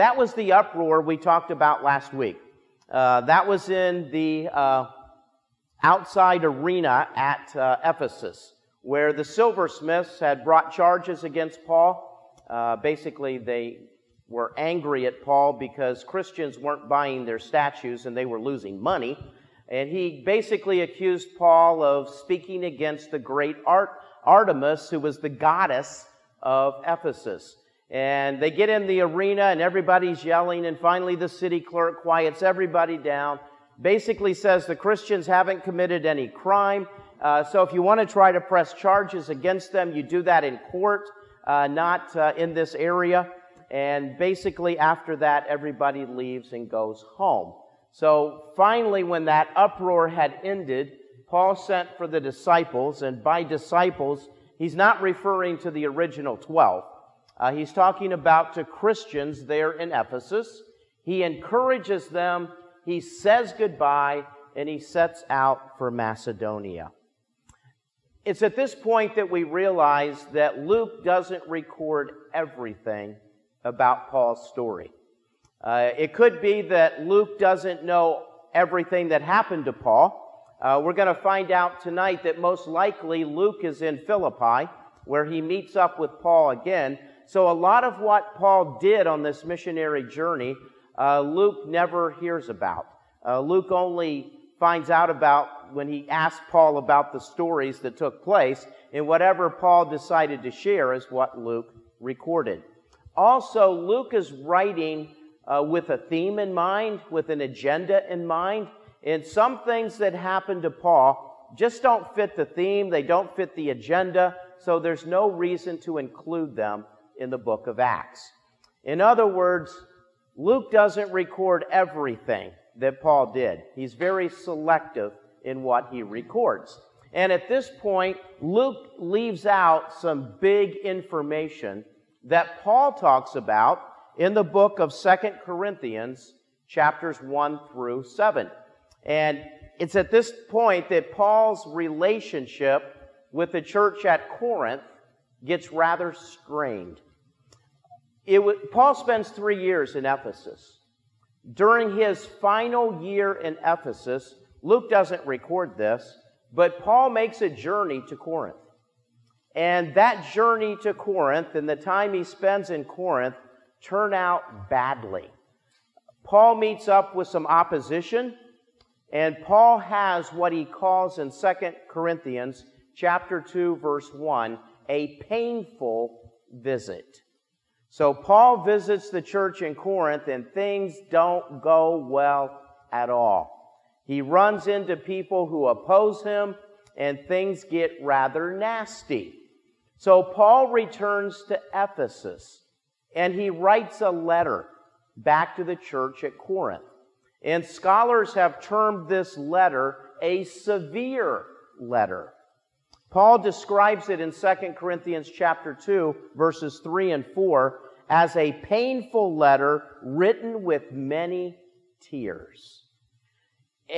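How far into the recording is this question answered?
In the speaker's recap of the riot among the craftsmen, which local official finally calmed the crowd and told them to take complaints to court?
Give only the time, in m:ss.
0:31.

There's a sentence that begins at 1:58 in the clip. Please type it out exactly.
In other words, Luke doesn't record everything that Paul did, he's very selective in what he records.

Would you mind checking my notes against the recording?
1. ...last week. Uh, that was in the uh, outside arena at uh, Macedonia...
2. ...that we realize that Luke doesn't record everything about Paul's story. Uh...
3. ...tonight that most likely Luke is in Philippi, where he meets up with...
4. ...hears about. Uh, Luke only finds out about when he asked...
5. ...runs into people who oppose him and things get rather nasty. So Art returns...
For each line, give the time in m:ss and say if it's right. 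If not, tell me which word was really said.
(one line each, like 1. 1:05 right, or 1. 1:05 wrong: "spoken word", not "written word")
1. 0:01 wrong: "Ephesus", not "Macedonia"
2. 1:09 right
3. 1:21 right
4. 1:32 right
5. 3:04 wrong: "Paul", not "Art".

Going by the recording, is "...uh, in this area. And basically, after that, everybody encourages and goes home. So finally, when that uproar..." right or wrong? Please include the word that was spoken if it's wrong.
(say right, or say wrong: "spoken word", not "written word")
wrong: "leaves", not "encourages".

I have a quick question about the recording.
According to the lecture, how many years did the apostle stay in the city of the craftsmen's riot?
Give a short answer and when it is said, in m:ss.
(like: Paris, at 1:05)
3, at 2:29.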